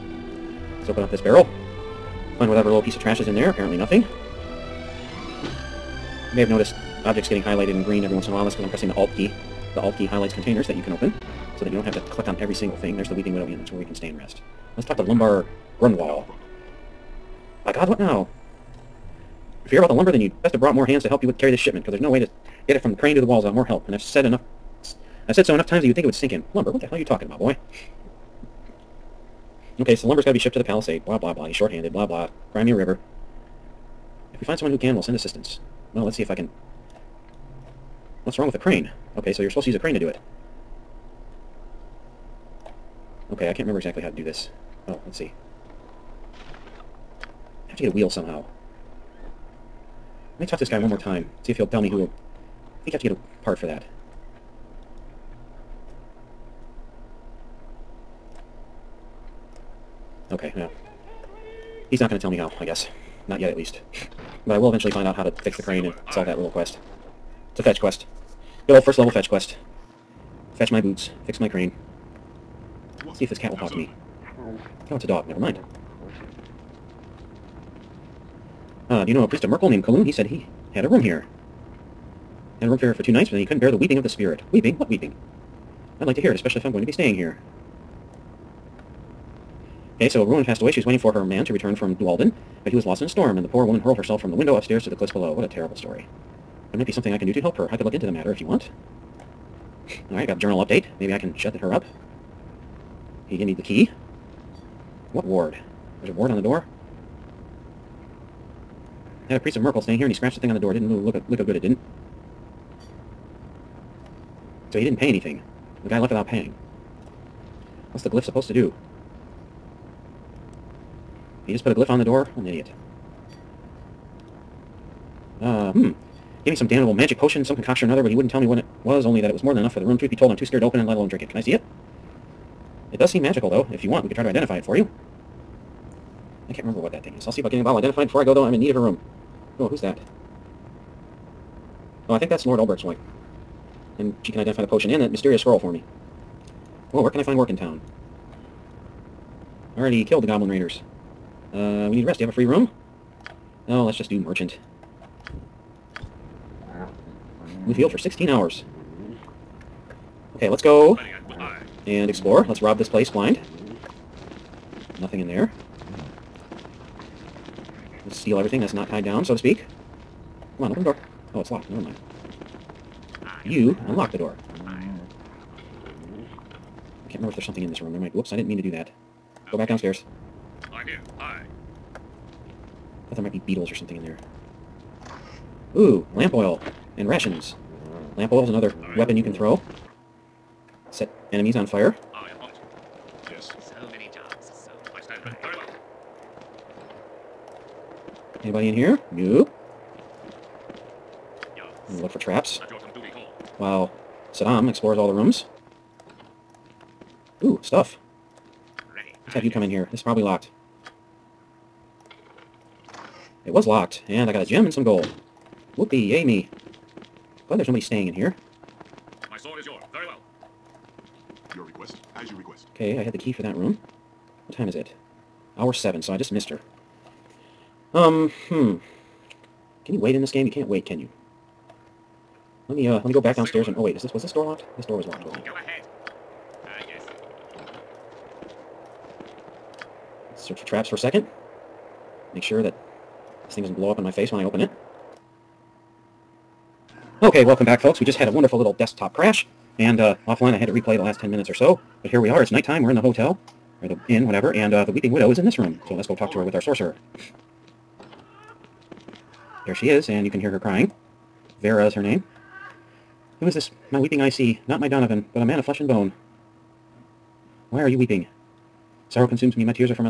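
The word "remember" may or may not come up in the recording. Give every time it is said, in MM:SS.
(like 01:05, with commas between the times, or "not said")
00:43, 02:16, 02:57.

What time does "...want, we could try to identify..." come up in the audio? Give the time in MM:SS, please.
02:13.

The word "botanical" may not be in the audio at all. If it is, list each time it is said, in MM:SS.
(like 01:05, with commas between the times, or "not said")
not said.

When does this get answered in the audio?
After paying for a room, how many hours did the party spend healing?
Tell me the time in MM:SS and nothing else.
02:37.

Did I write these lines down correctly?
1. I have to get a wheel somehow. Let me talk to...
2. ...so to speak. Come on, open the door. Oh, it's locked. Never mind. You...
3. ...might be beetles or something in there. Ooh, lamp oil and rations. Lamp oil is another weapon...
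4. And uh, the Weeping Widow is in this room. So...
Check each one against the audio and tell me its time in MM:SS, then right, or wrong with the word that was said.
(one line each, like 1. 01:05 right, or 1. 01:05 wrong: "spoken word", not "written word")
1. 00:47 right
2. 02:49 right
3. 03:03 right
4. 04:14 right.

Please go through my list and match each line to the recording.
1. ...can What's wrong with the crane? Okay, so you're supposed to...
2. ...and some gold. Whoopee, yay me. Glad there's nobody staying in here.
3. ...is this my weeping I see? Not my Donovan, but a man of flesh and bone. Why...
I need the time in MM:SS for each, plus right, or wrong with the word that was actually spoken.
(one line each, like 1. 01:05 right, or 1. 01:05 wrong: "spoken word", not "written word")
1. 00:36 right
2. 03:34 right
3. 04:23 right.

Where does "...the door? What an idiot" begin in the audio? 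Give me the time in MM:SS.
02:01.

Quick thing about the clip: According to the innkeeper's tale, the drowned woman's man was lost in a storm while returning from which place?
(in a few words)
Dualden.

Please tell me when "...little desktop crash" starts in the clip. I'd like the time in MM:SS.
04:08.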